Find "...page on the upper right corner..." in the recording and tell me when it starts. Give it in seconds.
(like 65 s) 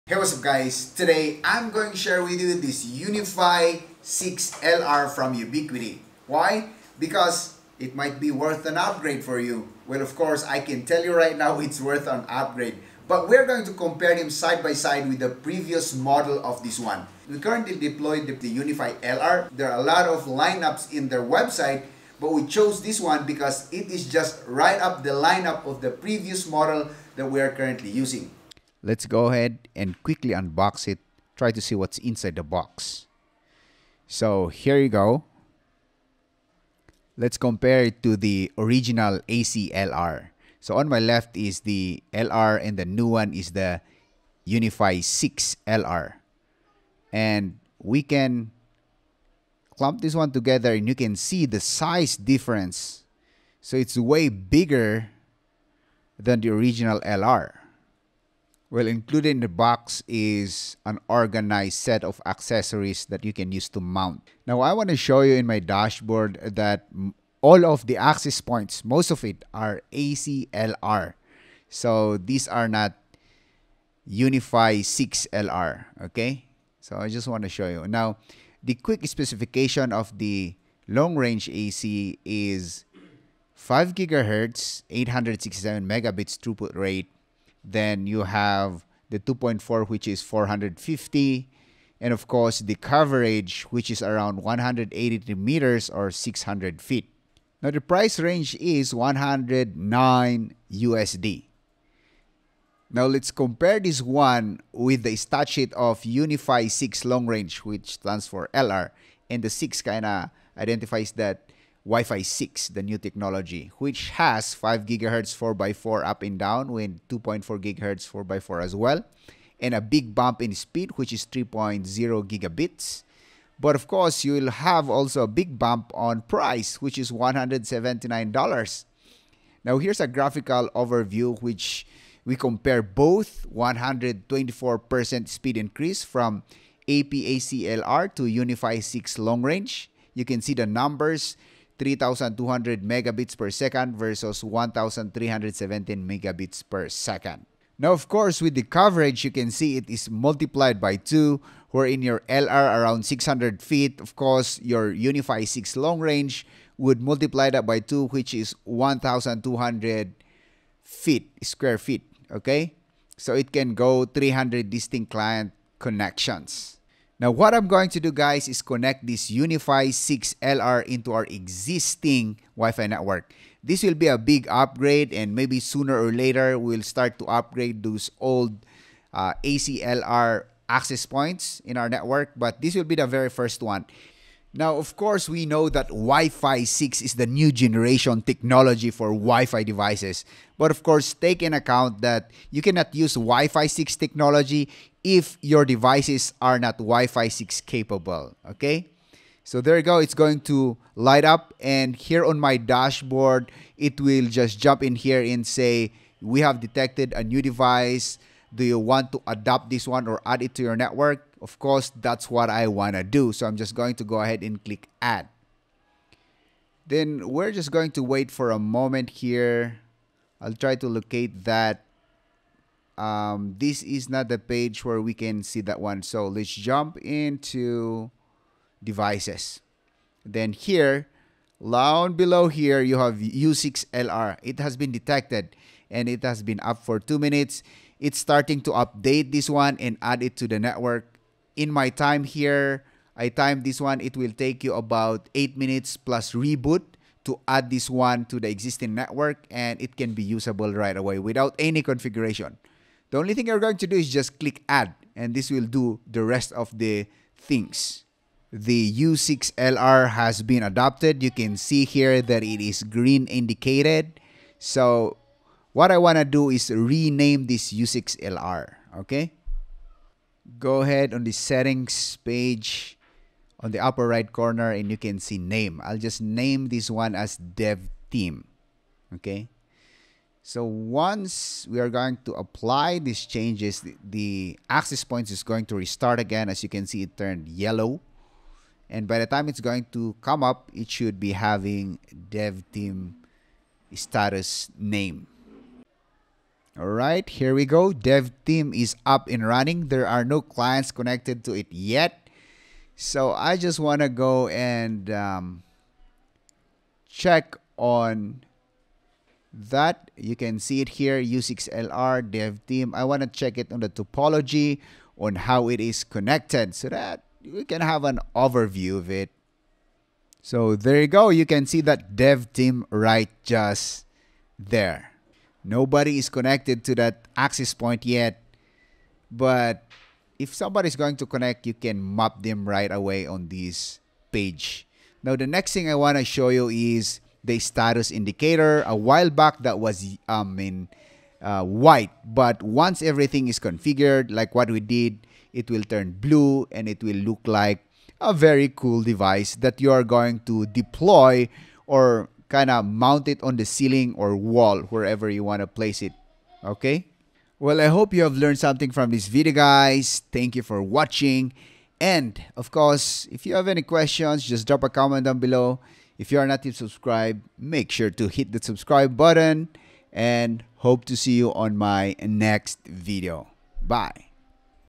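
272 s.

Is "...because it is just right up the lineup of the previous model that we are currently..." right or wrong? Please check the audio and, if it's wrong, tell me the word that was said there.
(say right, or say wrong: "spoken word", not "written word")
right.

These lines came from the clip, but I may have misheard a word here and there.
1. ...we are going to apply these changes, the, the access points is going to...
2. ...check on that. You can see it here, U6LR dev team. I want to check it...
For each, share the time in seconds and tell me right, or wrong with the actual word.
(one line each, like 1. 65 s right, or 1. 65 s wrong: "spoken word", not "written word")
1. 281 s right
2. 307 s right.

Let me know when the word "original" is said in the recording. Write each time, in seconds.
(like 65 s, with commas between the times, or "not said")
38 s, 56 s.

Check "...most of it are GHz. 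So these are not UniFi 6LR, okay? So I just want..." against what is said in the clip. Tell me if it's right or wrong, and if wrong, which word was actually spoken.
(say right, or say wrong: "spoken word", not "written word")
wrong: "ACLR", not "GHz".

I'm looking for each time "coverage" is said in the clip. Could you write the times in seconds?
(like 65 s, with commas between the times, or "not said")
92 s, 148 s.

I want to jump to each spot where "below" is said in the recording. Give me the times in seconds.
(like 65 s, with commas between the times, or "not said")
232 s, 365 s.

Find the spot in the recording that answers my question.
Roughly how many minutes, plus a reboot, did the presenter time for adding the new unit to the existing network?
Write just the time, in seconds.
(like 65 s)
245 s.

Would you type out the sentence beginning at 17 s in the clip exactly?
We currently deployed the UniFi LR.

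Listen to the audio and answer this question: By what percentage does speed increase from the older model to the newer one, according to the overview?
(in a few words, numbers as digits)
124%.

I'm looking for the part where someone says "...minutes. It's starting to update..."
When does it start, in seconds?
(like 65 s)
237 s.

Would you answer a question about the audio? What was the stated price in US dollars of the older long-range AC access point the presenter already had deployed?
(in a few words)
$109.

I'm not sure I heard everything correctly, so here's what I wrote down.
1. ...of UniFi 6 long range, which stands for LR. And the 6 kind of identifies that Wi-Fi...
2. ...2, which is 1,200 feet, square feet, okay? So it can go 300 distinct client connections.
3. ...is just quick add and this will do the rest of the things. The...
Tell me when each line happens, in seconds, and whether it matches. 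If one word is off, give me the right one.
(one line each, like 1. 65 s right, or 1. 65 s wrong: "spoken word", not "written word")
1. 105 s right
2. 157 s right
3. 253 s wrong: "click", not "quick".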